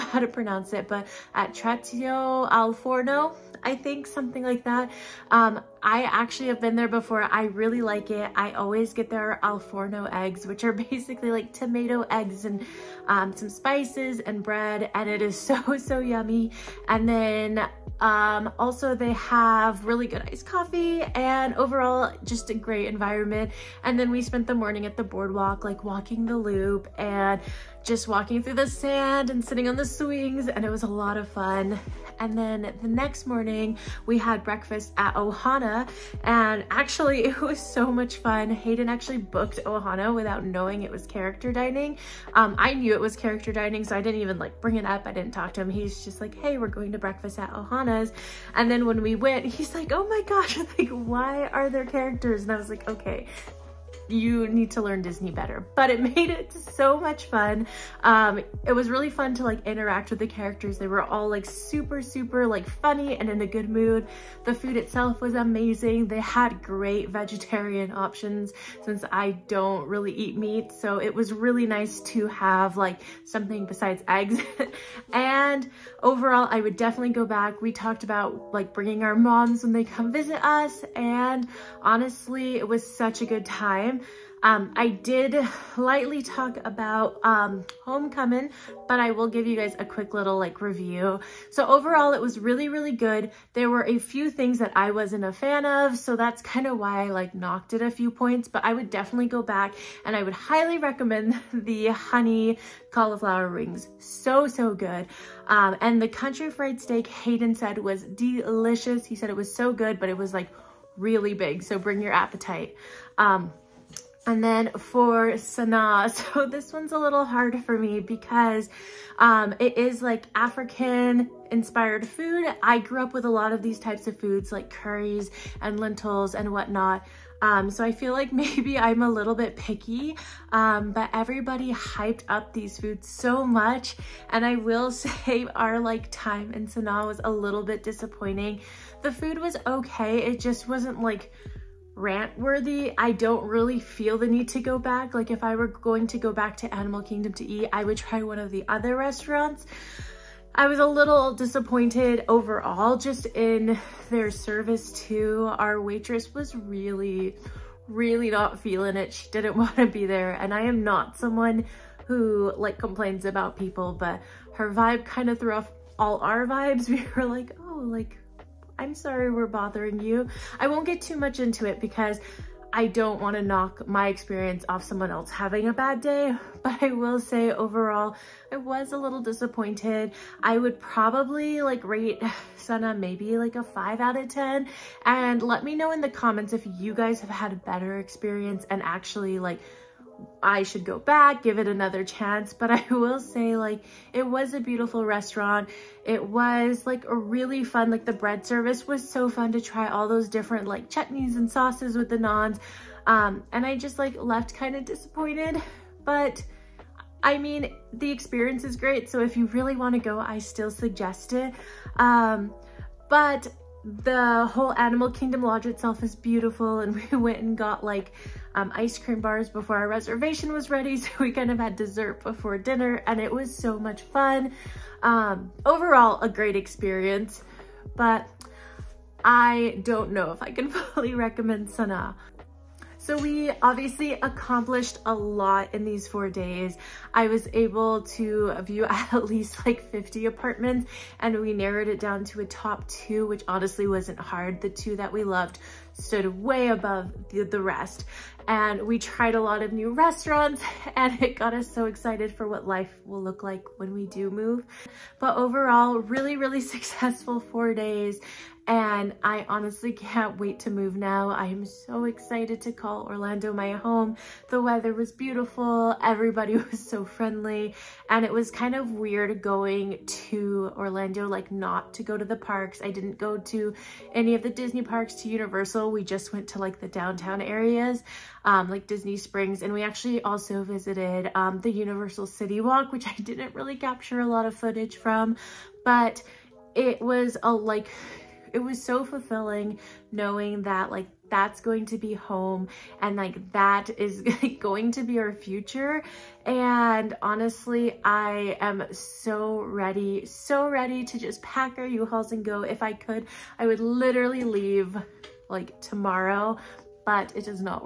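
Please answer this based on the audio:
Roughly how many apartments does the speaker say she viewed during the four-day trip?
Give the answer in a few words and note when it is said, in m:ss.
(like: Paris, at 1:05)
50, at 3:59.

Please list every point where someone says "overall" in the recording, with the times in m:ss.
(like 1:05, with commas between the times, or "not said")
0:21, 1:16, 1:31, 2:32, 2:57, 3:45, 4:15.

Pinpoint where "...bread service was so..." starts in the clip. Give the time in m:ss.
3:18.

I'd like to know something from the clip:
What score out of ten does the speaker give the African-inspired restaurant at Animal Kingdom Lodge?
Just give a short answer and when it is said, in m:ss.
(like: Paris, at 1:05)
5, at 3:03.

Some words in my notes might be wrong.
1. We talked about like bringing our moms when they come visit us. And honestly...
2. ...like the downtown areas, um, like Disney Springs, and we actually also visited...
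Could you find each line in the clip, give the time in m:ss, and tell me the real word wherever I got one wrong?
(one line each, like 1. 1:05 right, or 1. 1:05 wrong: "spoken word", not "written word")
1. 1:17 right
2. 4:36 right.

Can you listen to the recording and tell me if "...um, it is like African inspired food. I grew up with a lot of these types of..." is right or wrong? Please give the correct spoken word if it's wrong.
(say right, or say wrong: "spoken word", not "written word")
right.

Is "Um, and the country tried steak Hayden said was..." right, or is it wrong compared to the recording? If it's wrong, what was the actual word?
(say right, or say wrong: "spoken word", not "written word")
wrong: "fried", not "tried".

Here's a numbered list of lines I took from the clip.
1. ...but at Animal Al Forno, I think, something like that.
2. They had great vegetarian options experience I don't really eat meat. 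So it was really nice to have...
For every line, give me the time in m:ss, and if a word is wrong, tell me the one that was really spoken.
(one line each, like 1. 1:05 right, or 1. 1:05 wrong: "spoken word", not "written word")
1. 0:00 wrong: "Trattoria", not "Animal"
2. 1:06 wrong: "since", not "experience".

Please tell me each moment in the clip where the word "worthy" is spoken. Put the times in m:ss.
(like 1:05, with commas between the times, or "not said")
2:22.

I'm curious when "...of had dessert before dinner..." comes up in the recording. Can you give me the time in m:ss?
3:41.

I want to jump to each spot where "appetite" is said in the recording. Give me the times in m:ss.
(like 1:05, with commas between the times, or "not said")
1:52.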